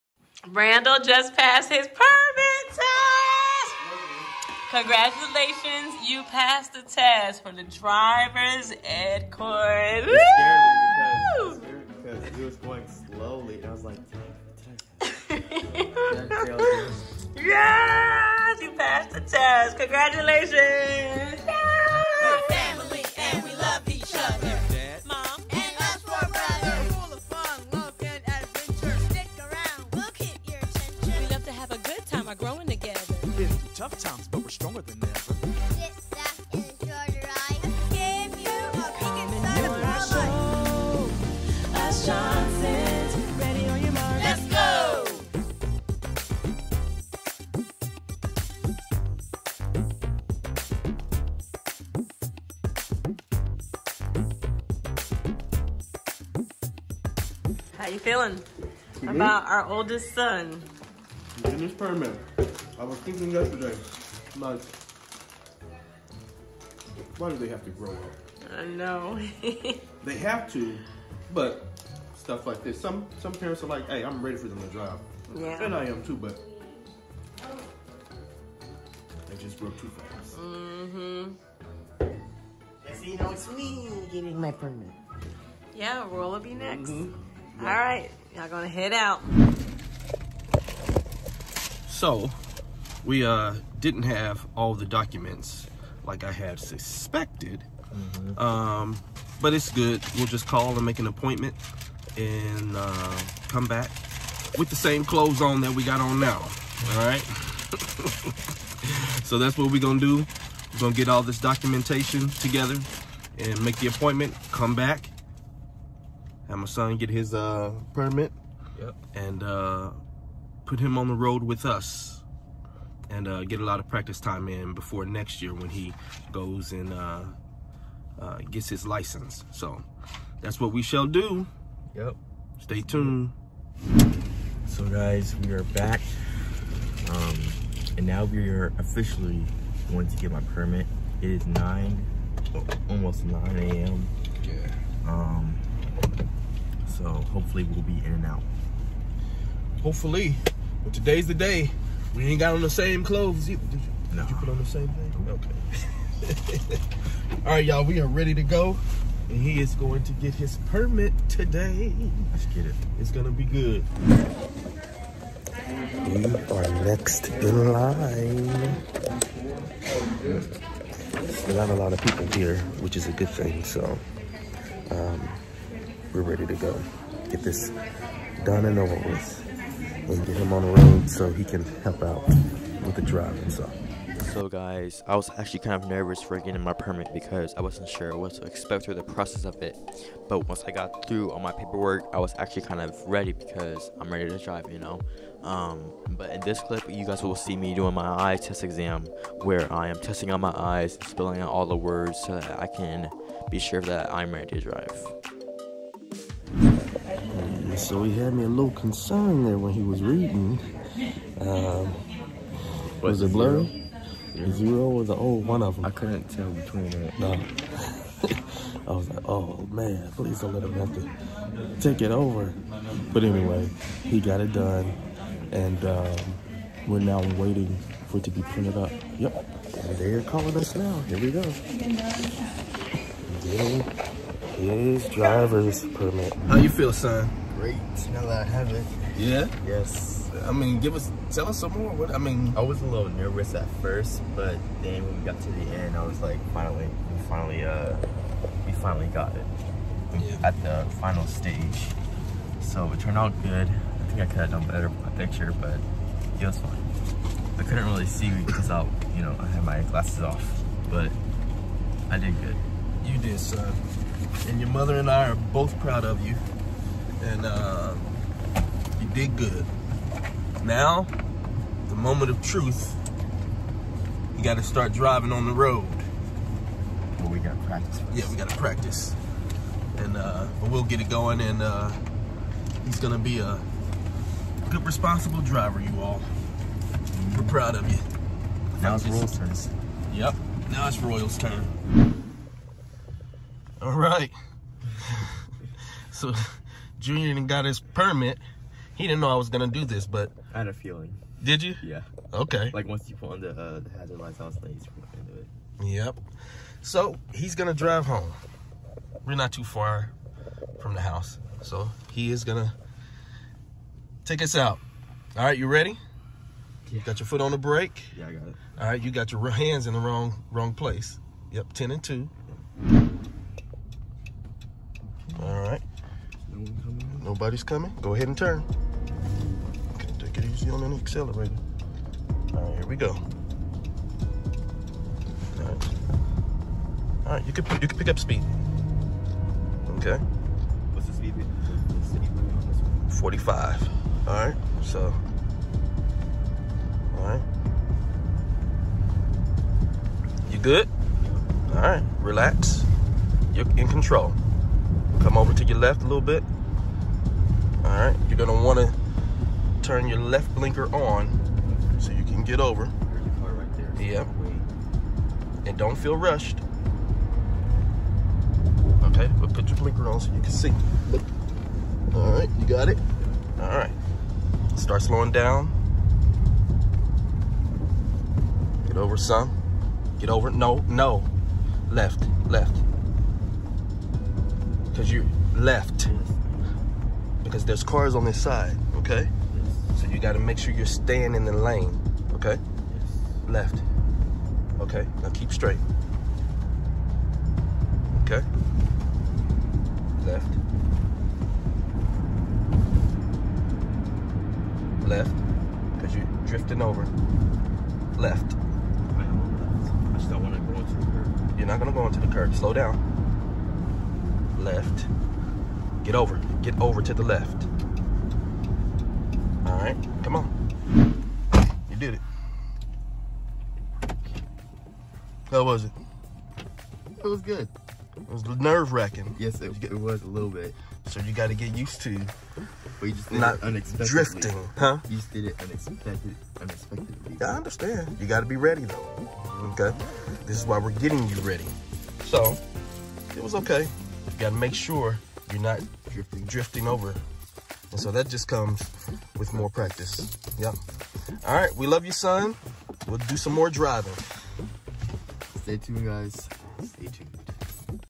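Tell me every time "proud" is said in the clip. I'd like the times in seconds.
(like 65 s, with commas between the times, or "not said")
265 s, 287 s.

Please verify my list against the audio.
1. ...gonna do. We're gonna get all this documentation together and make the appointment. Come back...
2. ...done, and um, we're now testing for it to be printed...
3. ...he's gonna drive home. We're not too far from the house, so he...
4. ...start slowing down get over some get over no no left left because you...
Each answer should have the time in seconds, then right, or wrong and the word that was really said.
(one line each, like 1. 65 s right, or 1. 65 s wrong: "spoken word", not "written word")
1. 109 s right
2. 224 s wrong: "waiting", not "testing"
3. 307 s right
4. 374 s right.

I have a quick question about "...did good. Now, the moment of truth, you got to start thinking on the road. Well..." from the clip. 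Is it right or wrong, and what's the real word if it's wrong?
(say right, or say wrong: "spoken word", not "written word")
wrong: "driving", not "thinking".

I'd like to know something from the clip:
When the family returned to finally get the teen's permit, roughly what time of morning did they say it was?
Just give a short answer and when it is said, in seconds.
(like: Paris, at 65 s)
Almost 9 a.m., at 142 s.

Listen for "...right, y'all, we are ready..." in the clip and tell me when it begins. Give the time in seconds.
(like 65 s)
157 s.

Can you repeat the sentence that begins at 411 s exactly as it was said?
You're not going to go into the curb.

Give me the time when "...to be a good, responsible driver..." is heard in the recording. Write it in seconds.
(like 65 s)
283 s.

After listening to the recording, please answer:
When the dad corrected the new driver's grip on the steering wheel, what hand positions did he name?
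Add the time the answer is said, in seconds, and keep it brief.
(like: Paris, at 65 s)
Ten and two, at 321 s.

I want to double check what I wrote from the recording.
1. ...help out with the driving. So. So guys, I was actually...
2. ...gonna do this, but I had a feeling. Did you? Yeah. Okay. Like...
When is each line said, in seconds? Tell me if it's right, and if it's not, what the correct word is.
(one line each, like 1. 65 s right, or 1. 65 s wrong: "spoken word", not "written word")
1. 181 s right
2. 299 s right.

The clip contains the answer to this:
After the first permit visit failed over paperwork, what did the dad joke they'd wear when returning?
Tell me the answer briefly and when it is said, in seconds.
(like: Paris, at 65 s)
Same clothes on, at 104 s.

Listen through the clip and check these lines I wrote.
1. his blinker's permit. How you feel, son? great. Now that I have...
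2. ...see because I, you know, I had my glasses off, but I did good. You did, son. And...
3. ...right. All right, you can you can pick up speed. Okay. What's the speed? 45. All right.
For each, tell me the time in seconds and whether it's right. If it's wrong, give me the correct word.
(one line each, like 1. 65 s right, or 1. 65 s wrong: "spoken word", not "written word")
1. 234 s wrong: "driver", not "blinker"
2. 258 s right
3. 335 s right.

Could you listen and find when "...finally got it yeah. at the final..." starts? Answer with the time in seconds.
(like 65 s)
248 s.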